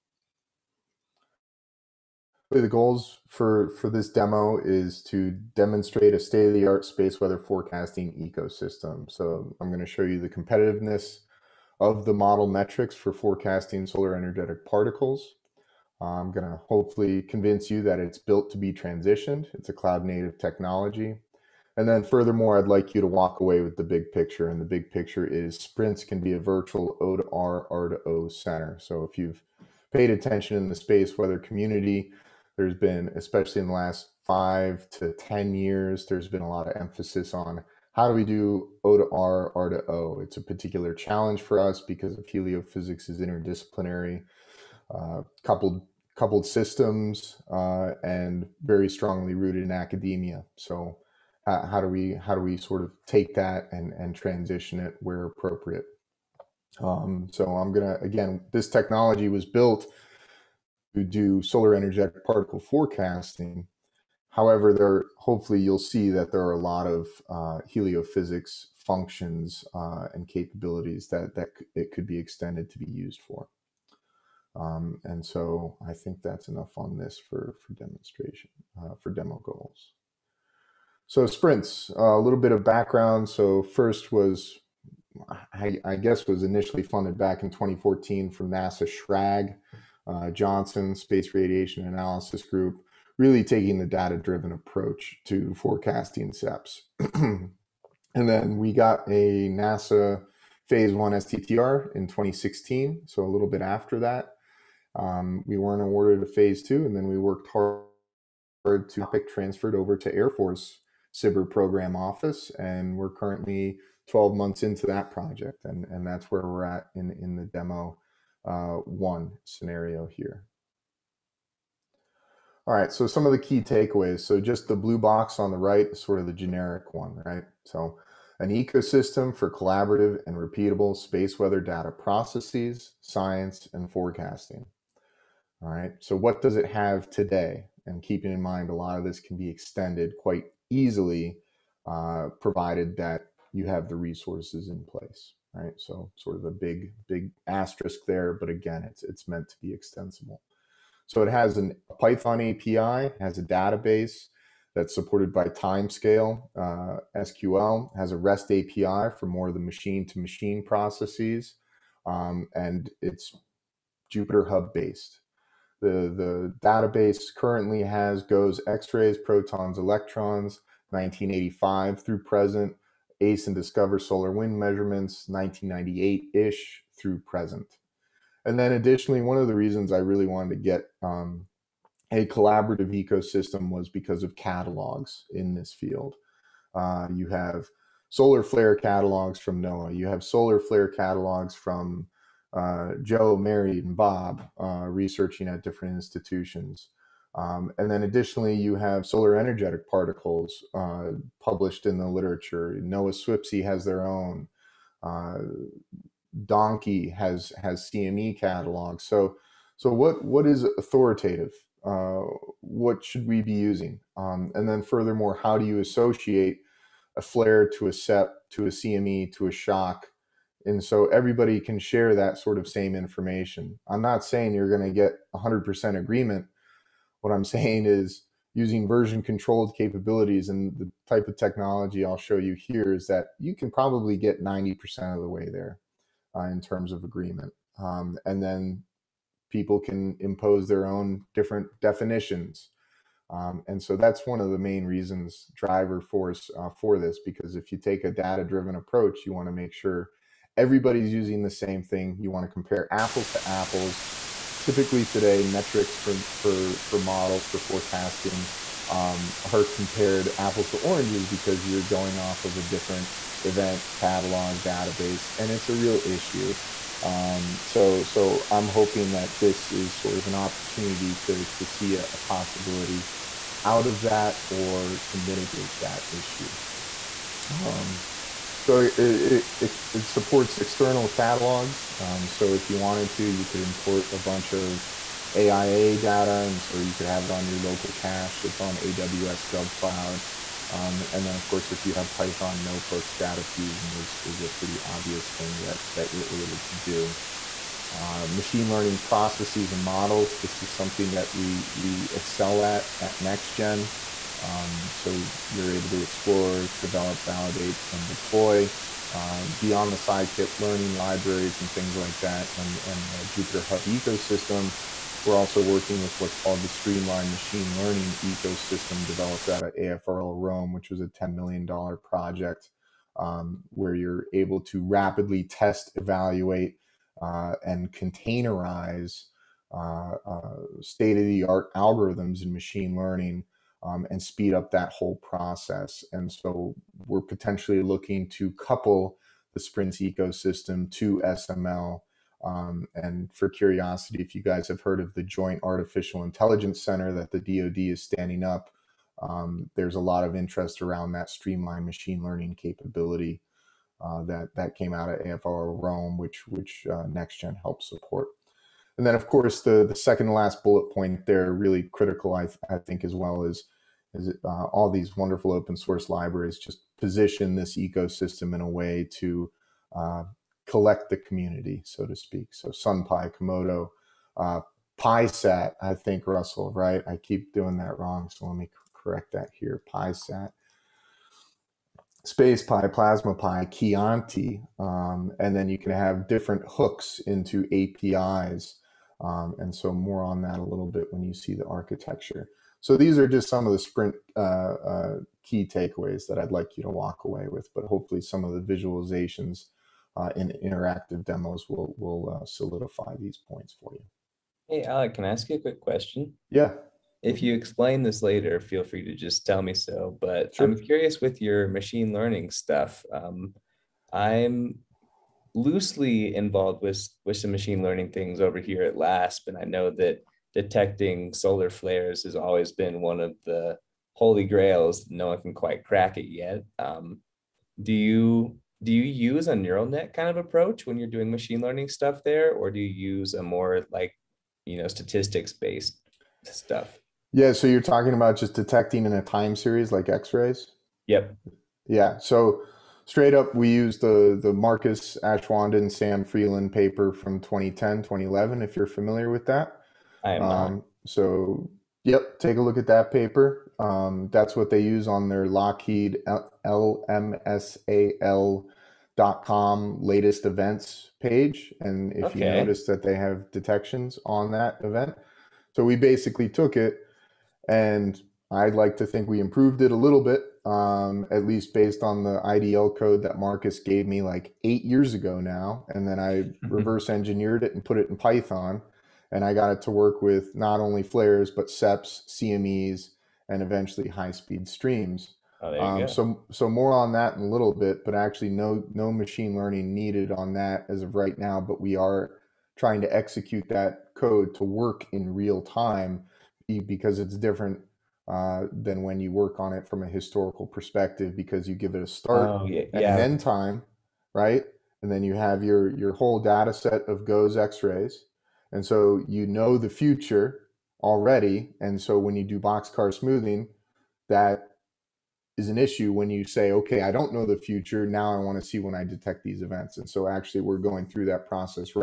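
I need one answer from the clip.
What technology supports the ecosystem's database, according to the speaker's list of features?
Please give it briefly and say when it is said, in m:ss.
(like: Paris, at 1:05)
Timescale, at 2:35.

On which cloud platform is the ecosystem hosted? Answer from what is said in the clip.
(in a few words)
AWS GovCloud.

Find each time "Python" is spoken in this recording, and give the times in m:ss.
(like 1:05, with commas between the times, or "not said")
2:31, 4:52, 7:58.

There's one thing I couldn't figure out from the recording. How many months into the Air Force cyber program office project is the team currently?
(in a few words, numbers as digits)
12.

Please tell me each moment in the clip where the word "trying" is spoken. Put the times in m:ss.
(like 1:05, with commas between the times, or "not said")
8:12.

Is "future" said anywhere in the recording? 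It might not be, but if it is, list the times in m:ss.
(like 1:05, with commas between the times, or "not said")
8:29, 8:37.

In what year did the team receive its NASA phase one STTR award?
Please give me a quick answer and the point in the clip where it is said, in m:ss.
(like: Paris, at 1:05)
2016, at 1:42.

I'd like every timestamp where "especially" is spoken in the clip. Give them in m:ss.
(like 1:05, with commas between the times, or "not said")
0:33.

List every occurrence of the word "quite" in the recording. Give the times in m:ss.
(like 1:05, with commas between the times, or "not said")
2:20, 7:05.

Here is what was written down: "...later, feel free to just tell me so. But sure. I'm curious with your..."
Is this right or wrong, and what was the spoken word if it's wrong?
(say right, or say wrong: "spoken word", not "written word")
right.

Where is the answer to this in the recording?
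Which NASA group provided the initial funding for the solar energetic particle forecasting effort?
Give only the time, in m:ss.
1:30.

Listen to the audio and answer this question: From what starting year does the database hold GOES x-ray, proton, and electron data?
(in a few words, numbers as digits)
1985.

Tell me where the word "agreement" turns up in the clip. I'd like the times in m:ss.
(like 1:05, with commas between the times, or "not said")
3:45, 3:57.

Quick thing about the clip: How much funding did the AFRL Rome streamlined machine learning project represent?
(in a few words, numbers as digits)
$10 million.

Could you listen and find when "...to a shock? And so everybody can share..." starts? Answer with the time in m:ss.
3:39.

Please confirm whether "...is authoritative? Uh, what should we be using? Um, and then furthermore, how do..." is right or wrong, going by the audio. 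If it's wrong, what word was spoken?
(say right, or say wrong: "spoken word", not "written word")
right.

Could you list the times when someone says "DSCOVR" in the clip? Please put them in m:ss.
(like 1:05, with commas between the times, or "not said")
2:53.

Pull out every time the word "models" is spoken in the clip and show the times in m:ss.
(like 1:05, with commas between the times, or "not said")
0:12, 4:16, 4:59.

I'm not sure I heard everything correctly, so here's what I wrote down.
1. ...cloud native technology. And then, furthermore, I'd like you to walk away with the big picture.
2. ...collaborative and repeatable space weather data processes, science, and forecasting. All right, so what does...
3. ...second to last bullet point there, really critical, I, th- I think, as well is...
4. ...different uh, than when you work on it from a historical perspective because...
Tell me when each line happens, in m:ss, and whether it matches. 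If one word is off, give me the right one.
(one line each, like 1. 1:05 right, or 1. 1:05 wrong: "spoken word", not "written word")
1. 0:19 right
2. 2:09 right
3. 5:59 right
4. 8:17 right.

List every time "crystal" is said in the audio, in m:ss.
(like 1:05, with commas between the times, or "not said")
not said.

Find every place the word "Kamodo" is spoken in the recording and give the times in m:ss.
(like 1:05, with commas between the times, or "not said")
6:13.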